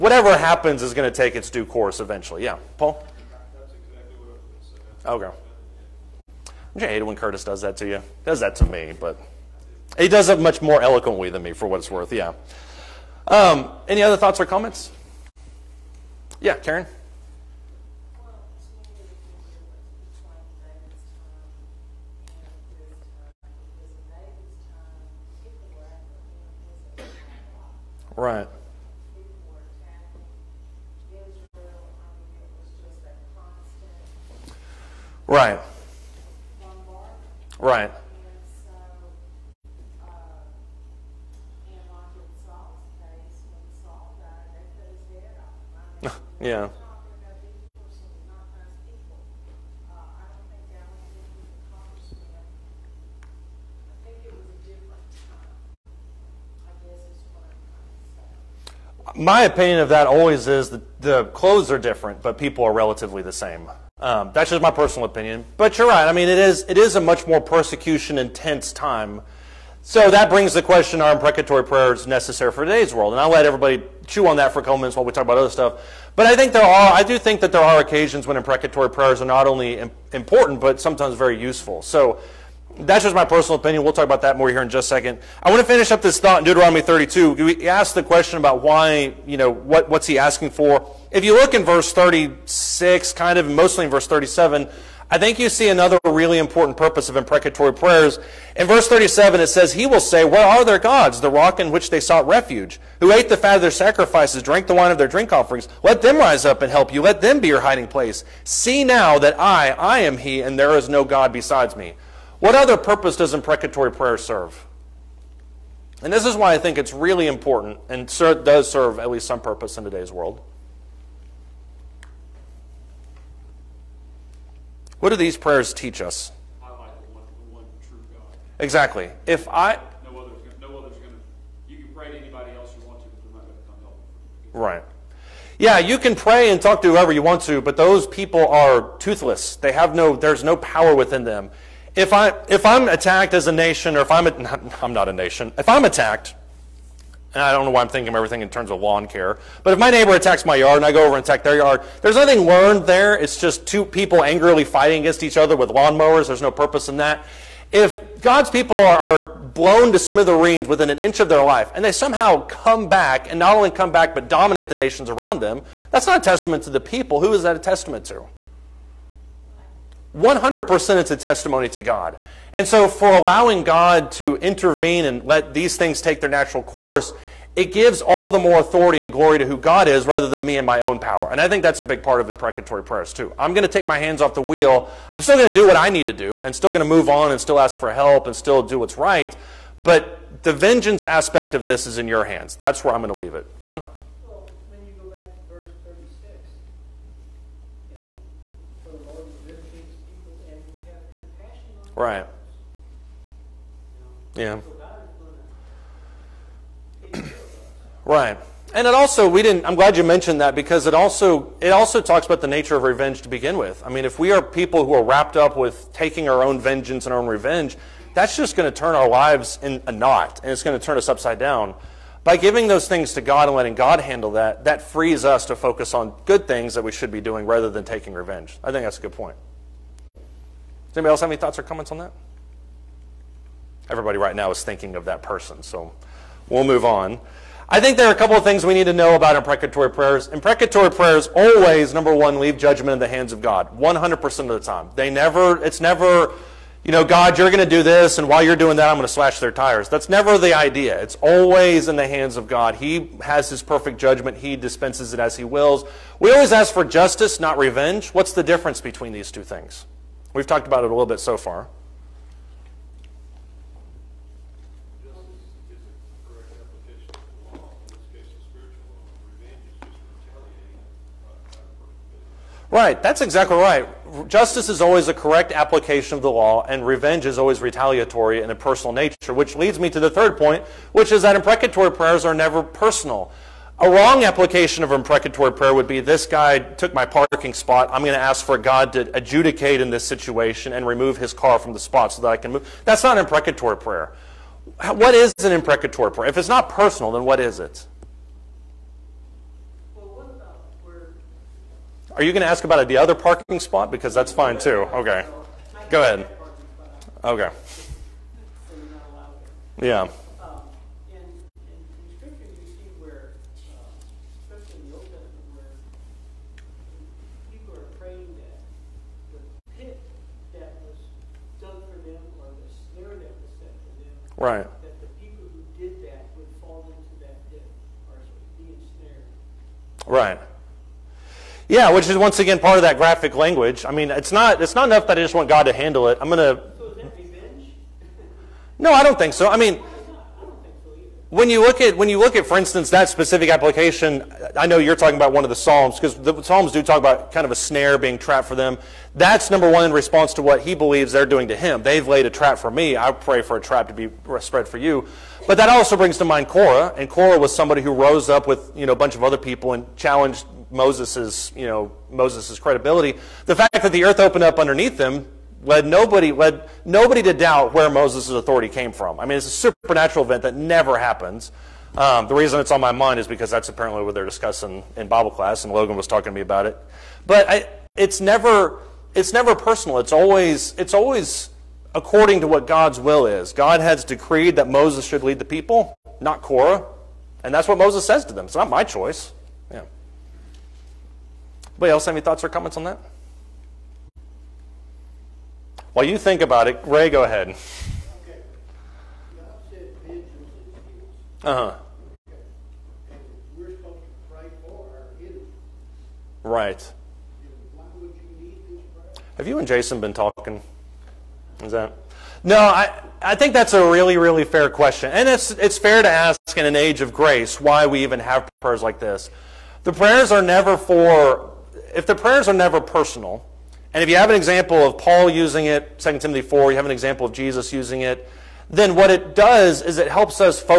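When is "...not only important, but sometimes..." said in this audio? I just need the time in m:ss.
1:19.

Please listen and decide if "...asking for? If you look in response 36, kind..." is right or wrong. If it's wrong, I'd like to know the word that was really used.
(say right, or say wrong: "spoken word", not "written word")
wrong: "verse", not "response".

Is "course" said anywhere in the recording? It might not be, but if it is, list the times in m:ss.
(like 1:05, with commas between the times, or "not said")
0:01, 2:56.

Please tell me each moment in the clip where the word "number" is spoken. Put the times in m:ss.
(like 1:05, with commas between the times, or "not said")
4:01, 5:49.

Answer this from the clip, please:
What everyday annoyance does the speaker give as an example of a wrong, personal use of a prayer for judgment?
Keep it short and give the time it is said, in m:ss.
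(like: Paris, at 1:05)
parking spot, at 4:47.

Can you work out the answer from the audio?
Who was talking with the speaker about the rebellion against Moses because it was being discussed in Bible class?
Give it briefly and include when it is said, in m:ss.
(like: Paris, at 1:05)
Logan, at 6:15.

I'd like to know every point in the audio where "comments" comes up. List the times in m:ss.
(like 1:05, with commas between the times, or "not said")
0:14, 3:51, 6:32.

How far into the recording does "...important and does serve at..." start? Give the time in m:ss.
1:57.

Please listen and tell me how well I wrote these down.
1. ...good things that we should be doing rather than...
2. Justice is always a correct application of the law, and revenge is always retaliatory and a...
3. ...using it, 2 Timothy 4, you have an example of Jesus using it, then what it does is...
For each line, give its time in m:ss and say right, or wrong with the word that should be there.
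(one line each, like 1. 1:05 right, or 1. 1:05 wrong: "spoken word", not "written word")
1. 3:46 right
2. 4:34 right
3. 7:05 right.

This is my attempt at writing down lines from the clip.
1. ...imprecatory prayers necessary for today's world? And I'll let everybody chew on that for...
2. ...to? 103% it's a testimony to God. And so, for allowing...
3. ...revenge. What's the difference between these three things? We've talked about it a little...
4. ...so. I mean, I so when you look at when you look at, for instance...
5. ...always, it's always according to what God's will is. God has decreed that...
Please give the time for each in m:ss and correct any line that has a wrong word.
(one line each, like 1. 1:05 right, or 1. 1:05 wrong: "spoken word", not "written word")
1. 1:11 right
2. 2:48 wrong: "100", not "103"
3. 4:17 wrong: "two", not "three"
4. 5:39 right
5. 6:20 right.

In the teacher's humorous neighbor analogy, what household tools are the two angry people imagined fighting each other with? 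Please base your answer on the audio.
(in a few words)
lawnmowers.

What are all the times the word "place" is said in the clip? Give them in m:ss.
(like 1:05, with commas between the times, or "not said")
1:47.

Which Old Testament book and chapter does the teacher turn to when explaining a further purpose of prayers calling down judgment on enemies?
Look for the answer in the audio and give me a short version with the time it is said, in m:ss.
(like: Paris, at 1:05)
Deuteronomy 32, at 1:26.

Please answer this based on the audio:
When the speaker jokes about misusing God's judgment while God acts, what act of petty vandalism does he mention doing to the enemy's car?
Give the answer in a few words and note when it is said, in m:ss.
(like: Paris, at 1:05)
slash their tires, at 4:09.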